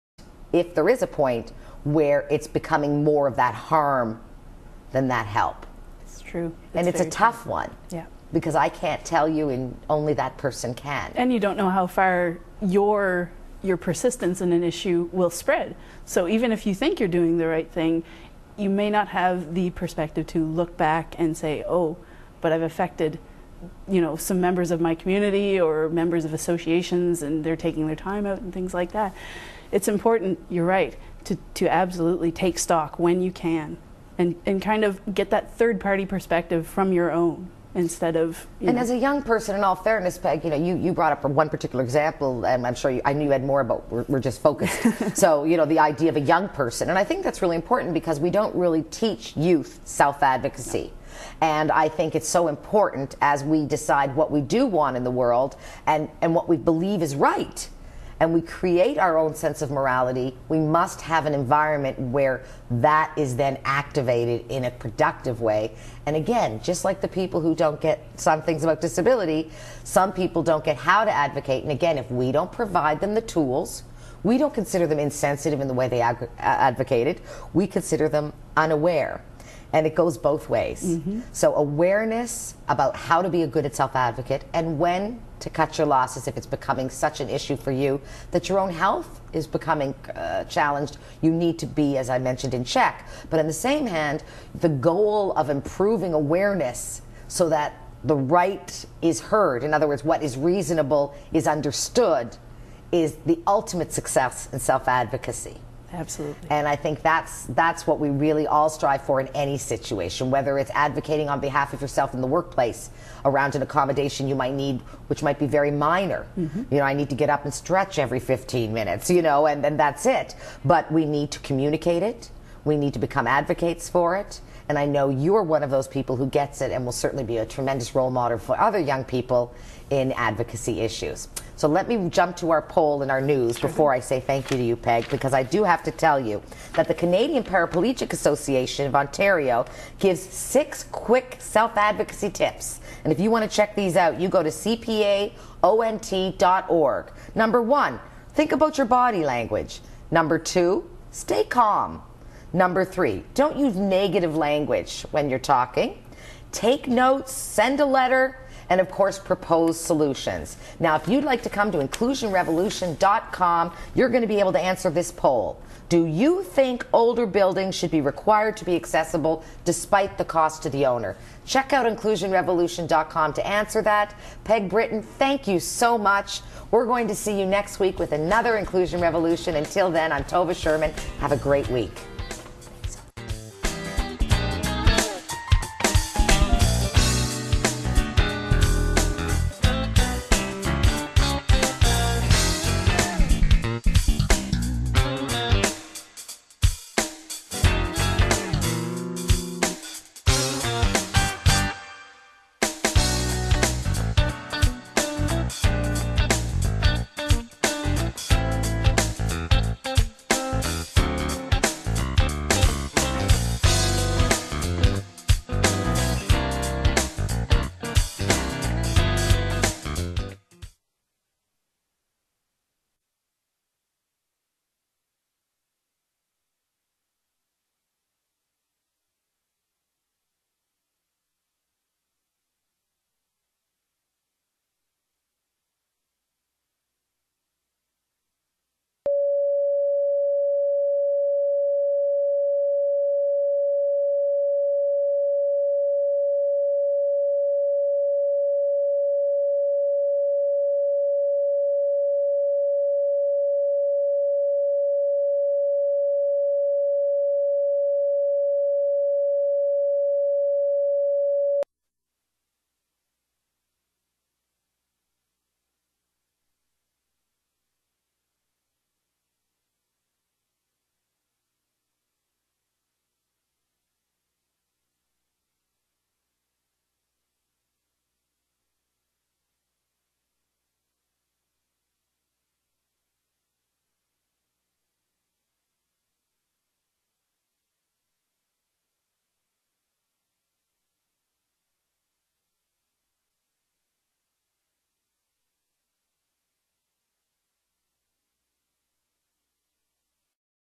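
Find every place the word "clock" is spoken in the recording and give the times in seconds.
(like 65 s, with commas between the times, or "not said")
not said.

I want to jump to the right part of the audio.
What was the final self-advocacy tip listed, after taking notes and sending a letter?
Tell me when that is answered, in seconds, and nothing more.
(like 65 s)
159 s.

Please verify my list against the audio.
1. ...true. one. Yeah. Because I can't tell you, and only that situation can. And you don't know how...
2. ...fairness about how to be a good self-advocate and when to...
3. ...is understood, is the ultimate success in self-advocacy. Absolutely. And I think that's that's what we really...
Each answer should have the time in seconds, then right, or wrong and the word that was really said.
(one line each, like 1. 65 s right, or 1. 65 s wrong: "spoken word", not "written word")
1. 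7 s wrong: "person", not "situation"
2. 81 s wrong: "awareness", not "fairness"
3. 101 s right.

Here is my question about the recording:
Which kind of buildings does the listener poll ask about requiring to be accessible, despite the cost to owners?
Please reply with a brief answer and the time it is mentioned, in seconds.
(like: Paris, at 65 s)
older buildings, at 166 s.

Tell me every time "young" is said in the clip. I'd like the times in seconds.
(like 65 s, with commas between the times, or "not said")
38 s, 46 s, 128 s.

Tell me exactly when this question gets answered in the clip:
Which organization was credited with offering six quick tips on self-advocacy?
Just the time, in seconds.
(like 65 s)
136 s.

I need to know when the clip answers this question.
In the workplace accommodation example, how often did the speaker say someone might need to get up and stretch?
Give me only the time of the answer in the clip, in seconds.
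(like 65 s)
117 s.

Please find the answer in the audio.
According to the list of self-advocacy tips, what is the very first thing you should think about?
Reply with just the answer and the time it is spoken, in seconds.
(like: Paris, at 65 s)
body language, at 148 s.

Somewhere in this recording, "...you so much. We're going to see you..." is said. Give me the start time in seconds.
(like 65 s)
175 s.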